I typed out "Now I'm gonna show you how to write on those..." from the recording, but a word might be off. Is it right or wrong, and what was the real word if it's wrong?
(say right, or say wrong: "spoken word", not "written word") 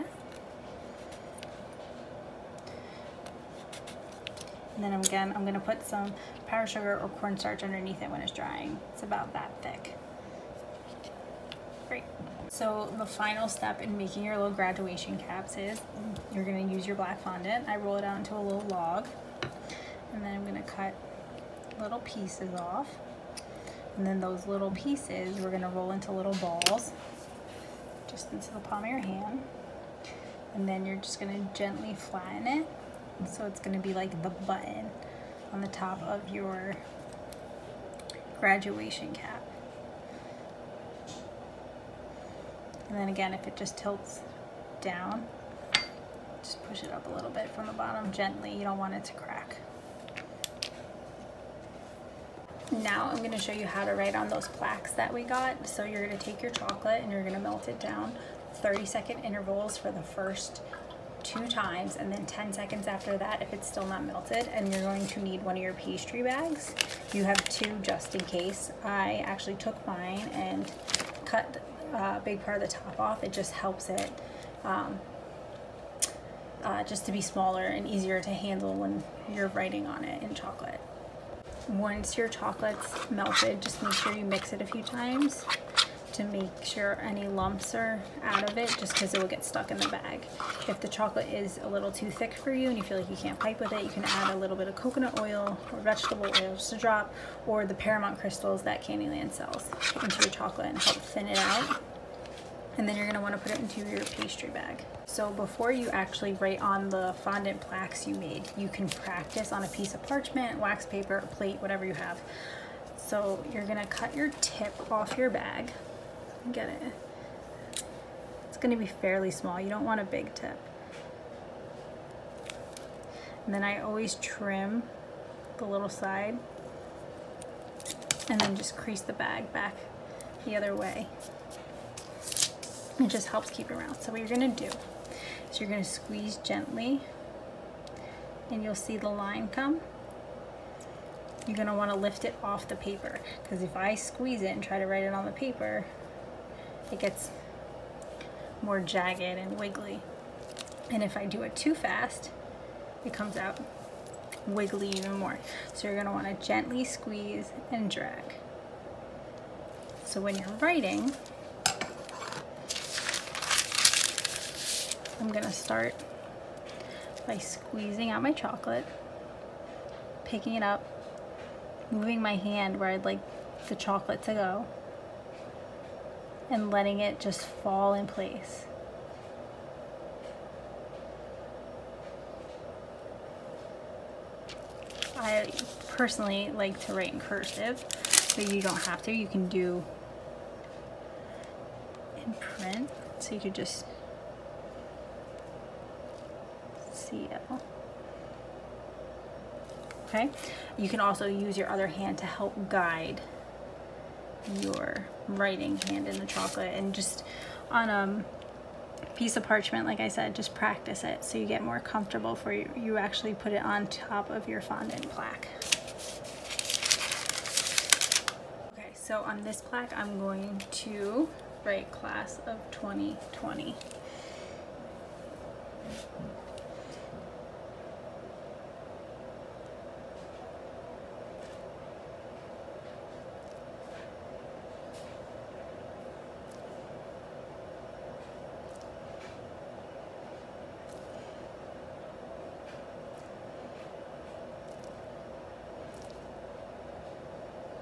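right.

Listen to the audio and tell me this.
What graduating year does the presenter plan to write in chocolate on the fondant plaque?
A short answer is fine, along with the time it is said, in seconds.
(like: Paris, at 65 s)
2020, at 222 s.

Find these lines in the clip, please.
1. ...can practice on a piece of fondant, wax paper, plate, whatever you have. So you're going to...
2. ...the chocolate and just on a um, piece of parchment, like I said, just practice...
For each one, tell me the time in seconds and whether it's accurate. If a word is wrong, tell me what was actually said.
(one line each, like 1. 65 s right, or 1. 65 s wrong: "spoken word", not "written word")
1. 108 s wrong: "parchment", not "fondant"
2. 206 s right.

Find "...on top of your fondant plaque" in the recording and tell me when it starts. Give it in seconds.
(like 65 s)
213 s.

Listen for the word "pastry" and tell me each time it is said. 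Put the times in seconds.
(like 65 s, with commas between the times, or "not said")
65 s, 104 s.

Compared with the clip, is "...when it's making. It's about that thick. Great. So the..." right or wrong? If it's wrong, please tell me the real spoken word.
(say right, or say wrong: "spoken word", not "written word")
wrong: "drying", not "making".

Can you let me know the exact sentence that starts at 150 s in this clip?
And if I do it too fast, it comes out wiggly even more.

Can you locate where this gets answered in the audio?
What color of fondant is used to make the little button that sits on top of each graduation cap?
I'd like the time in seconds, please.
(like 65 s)
16 s.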